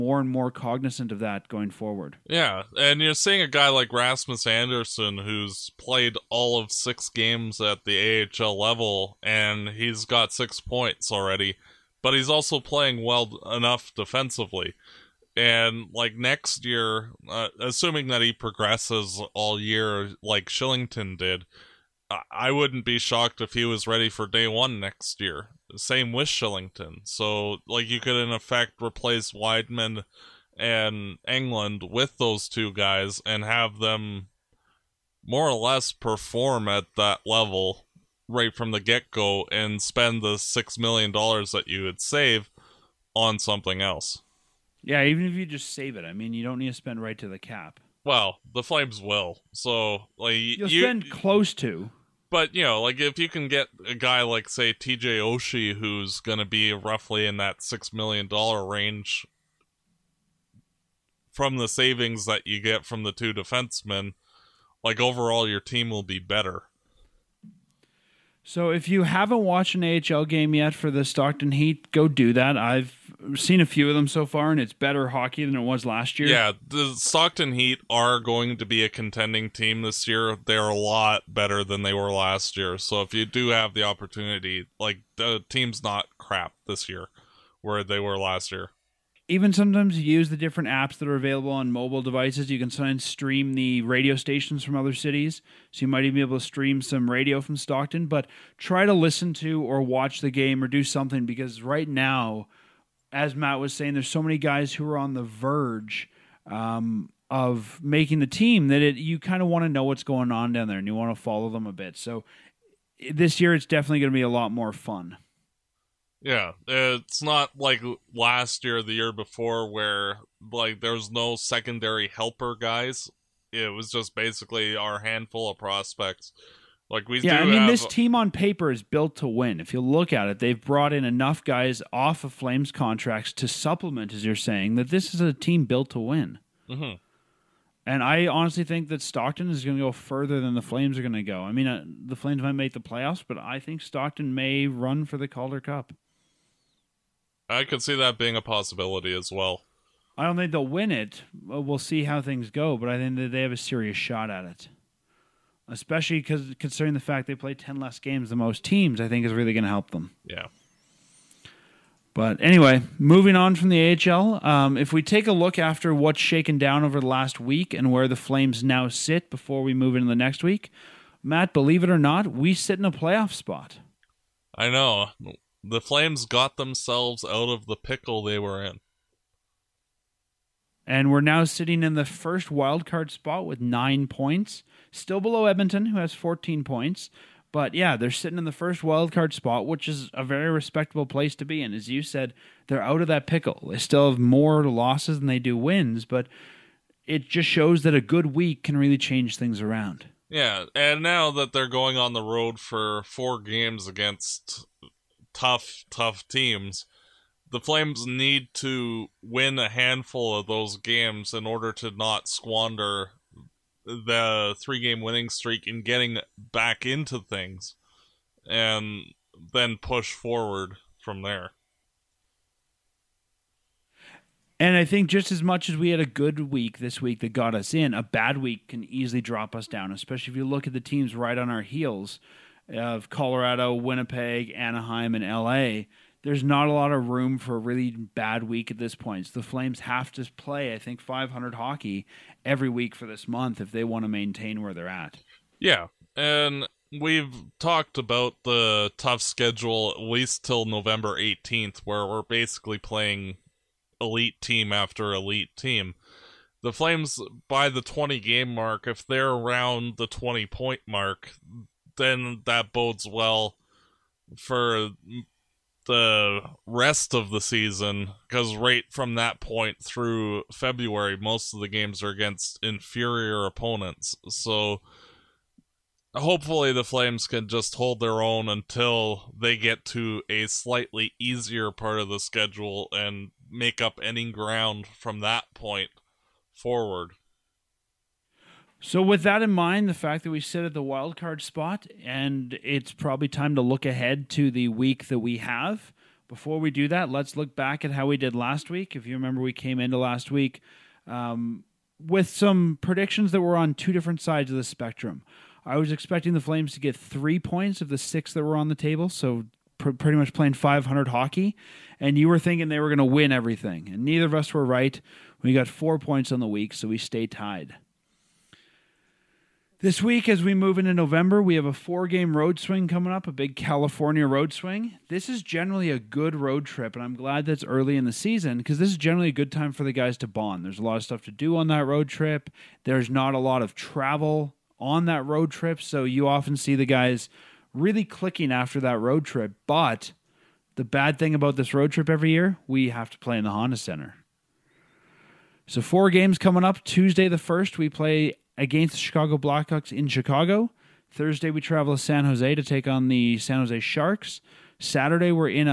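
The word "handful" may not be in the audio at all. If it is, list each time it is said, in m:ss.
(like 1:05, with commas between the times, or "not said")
2:04, 3:29.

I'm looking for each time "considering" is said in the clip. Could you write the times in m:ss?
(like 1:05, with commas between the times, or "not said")
2:36.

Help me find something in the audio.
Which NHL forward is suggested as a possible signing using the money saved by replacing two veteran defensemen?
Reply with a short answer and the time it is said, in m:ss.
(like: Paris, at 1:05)
TJ Oshie, at 0:54.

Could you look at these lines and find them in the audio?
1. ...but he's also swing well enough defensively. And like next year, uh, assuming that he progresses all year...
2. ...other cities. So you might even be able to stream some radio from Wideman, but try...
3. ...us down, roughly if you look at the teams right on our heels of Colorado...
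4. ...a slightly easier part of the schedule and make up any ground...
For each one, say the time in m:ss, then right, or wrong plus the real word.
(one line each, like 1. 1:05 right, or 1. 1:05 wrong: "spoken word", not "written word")
1. 0:12 wrong: "playing", not "swing"
2. 1:34 wrong: "Stockton", not "Wideman"
3. 3:49 wrong: "especially", not "roughly"
4. 4:40 right.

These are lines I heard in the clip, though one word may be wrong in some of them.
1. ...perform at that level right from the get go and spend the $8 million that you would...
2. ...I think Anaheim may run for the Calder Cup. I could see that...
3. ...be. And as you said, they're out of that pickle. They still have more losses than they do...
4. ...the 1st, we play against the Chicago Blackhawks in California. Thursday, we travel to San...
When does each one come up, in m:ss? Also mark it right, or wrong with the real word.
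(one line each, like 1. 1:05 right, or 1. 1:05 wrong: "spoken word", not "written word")
1. 0:35 wrong: "6", not "8"
2. 2:23 wrong: "Stockton", not "Anaheim"
3. 3:11 right
4. 5:47 wrong: "Chicago", not "California".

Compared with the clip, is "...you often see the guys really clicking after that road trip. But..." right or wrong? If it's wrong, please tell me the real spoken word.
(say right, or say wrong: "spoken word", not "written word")
right.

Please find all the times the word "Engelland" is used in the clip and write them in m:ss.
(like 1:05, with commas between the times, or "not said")
0:31.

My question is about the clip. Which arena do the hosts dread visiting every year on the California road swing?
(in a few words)
Honda Center.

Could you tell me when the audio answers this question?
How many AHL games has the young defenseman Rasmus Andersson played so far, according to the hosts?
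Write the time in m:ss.
0:06.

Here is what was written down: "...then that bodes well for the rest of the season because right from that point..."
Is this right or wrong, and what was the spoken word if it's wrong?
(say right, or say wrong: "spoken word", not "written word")
right.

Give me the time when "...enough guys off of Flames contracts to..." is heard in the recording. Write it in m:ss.
2:11.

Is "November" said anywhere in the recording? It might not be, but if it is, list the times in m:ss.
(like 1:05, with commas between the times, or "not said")
4:10, 5:20.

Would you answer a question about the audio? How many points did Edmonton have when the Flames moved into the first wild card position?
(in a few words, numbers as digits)
14.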